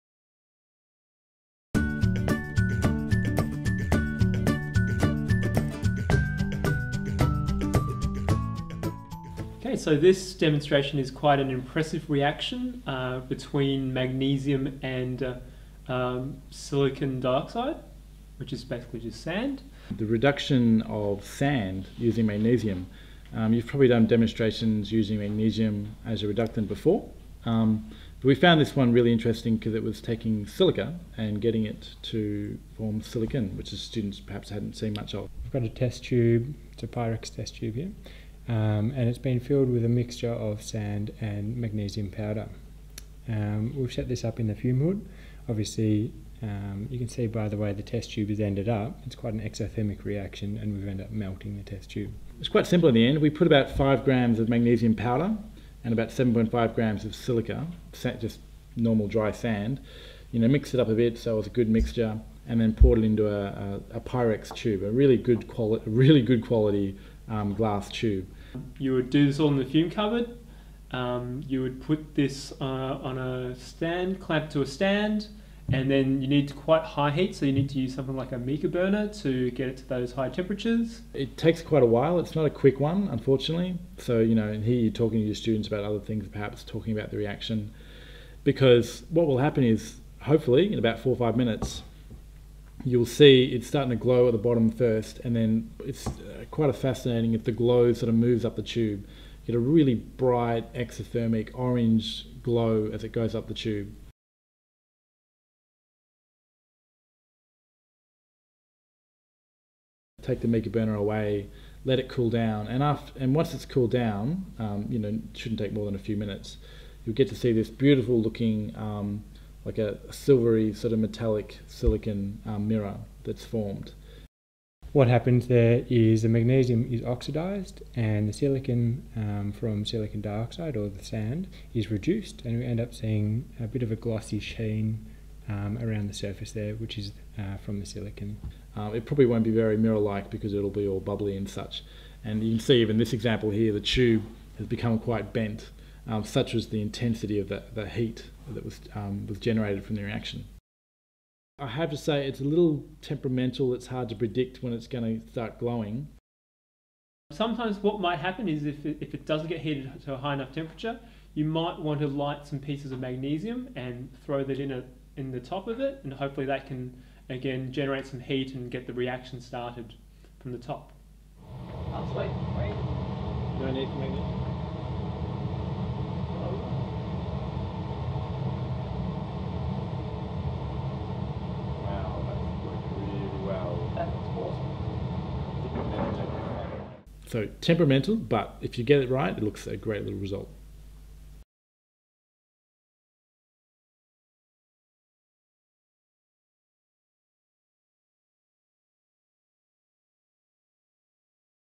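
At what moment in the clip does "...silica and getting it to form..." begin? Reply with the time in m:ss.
0:30.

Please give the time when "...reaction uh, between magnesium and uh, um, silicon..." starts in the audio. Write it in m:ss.
0:12.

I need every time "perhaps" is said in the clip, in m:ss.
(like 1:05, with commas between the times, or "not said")
0:34, 1:26.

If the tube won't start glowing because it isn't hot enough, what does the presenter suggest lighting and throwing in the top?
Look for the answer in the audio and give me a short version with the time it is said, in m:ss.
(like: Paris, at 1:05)
pieces of magnesium, at 2:42.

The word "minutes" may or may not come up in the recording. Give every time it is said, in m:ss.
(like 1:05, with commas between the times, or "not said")
1:31, 1:56.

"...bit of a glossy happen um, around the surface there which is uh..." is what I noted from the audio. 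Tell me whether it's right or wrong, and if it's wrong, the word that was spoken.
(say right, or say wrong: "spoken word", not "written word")
wrong: "sheen", not "happen".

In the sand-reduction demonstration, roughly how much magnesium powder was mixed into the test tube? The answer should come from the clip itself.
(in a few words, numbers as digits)
5 grams.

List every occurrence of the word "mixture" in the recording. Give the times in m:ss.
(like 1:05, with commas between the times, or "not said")
0:39, 1:01.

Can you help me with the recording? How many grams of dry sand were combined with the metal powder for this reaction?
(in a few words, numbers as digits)
7.5 grams.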